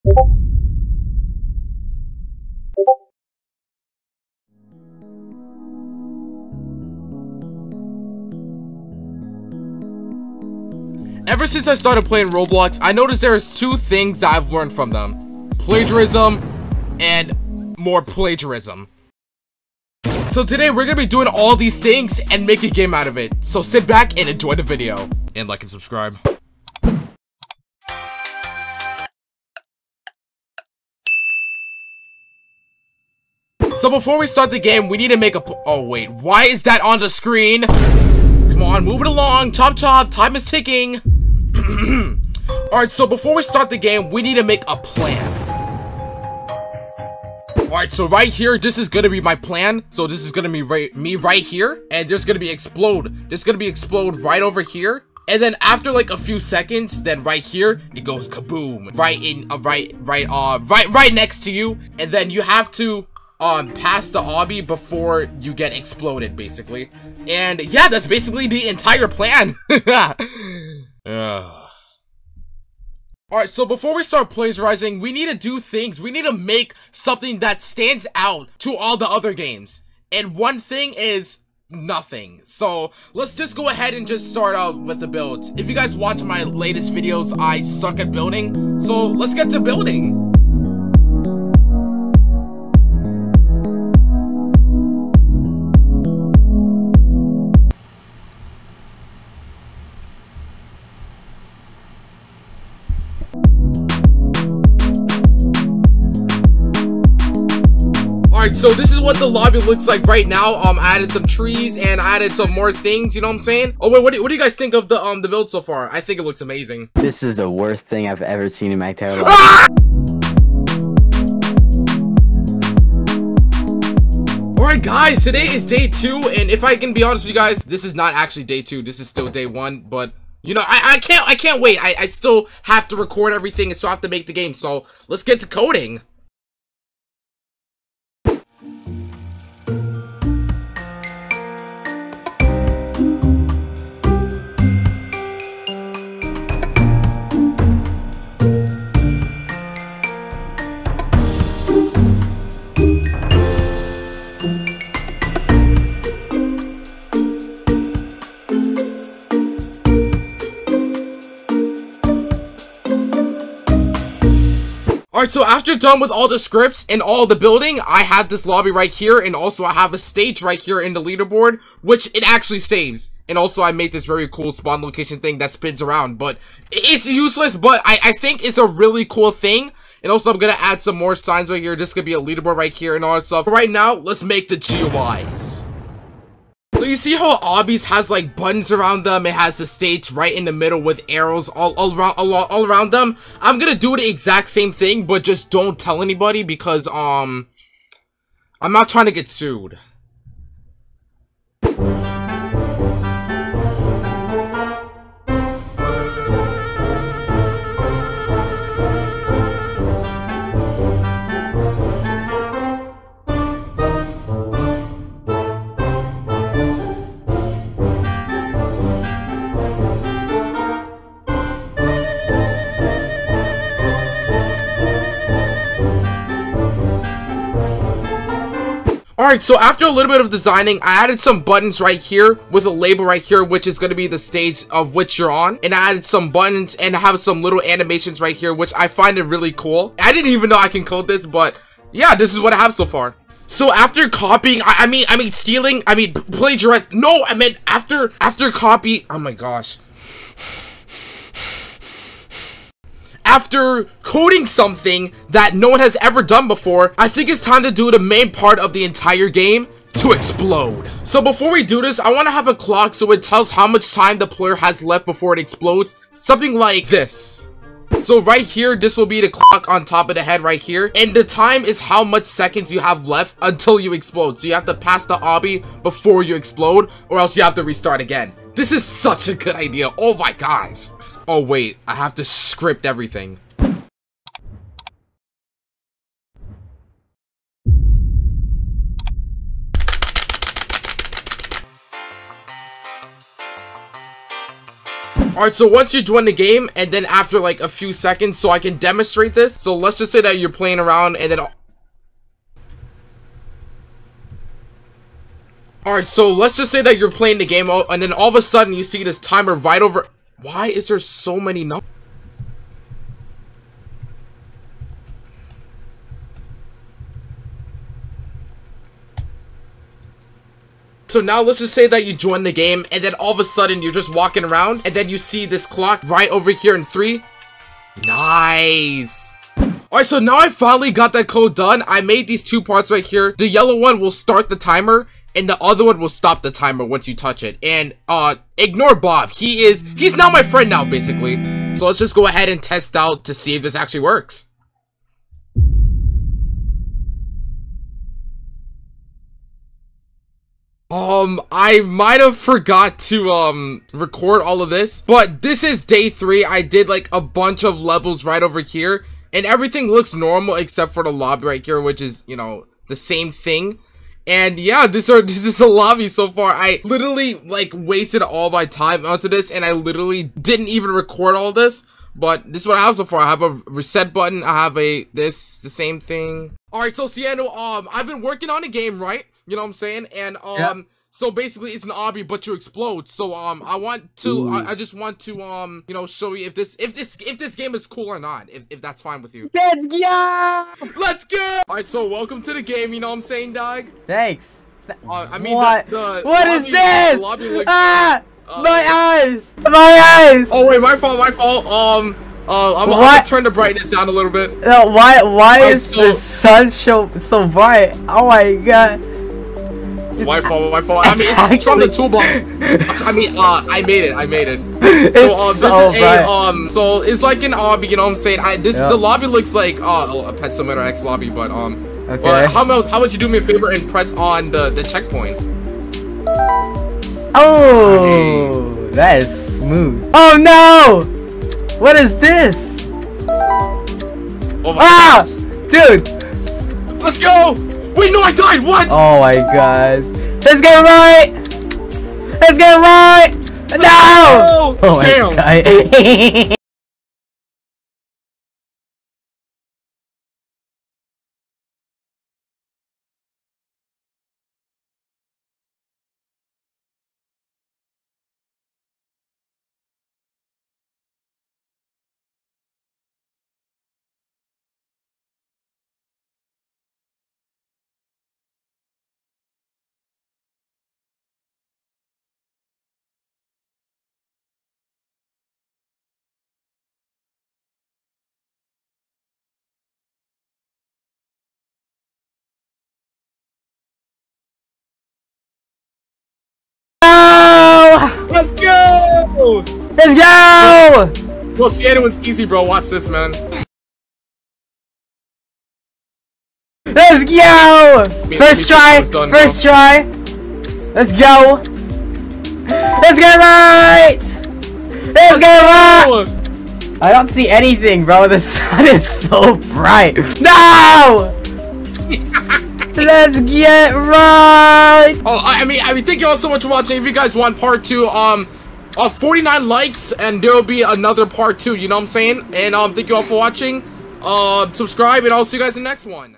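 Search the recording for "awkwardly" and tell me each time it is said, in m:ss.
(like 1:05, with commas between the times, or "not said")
not said.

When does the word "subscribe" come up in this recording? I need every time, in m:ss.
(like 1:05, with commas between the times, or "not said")
0:25, 8:44.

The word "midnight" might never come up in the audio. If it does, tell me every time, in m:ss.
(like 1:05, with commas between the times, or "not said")
not said.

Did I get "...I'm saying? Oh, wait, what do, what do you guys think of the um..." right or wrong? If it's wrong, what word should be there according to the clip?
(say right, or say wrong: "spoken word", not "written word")
right.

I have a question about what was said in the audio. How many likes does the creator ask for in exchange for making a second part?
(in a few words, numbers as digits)
49.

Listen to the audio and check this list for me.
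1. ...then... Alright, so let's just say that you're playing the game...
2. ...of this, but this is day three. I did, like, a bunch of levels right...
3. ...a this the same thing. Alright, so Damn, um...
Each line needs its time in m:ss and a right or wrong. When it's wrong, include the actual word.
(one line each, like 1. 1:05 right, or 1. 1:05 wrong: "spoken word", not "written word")
1. 5:01 right
2. 5:54 right
3. 6:14 wrong: "Ciano", not "Damn".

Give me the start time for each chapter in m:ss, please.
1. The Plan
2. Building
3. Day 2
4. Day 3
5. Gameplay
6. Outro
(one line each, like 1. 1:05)
1. 0:47
2. 1:30
3. 2:00
4. 5:45
5. 6:16
6. 8:35.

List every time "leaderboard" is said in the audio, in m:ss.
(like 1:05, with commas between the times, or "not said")
2:51, 3:02.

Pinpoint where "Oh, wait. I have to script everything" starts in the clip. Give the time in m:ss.
4:41.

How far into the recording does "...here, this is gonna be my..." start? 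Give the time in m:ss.
0:48.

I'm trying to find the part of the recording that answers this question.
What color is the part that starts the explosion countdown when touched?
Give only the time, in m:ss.
5:33.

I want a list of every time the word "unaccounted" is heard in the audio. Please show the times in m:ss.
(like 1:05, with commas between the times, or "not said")
not said.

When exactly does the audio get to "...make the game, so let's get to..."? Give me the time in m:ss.
2:14.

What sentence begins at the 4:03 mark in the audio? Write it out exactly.
So after copying, I, I, mean, I mean stealing, I mean plagiarizing.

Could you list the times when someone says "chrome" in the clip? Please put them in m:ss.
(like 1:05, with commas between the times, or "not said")
not said.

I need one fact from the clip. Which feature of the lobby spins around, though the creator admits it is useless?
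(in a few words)
Spawn location.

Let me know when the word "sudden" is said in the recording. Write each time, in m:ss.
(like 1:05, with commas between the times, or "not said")
5:08, 5:23.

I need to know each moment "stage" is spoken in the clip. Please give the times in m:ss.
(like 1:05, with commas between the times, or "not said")
2:49, 3:09, 3:54.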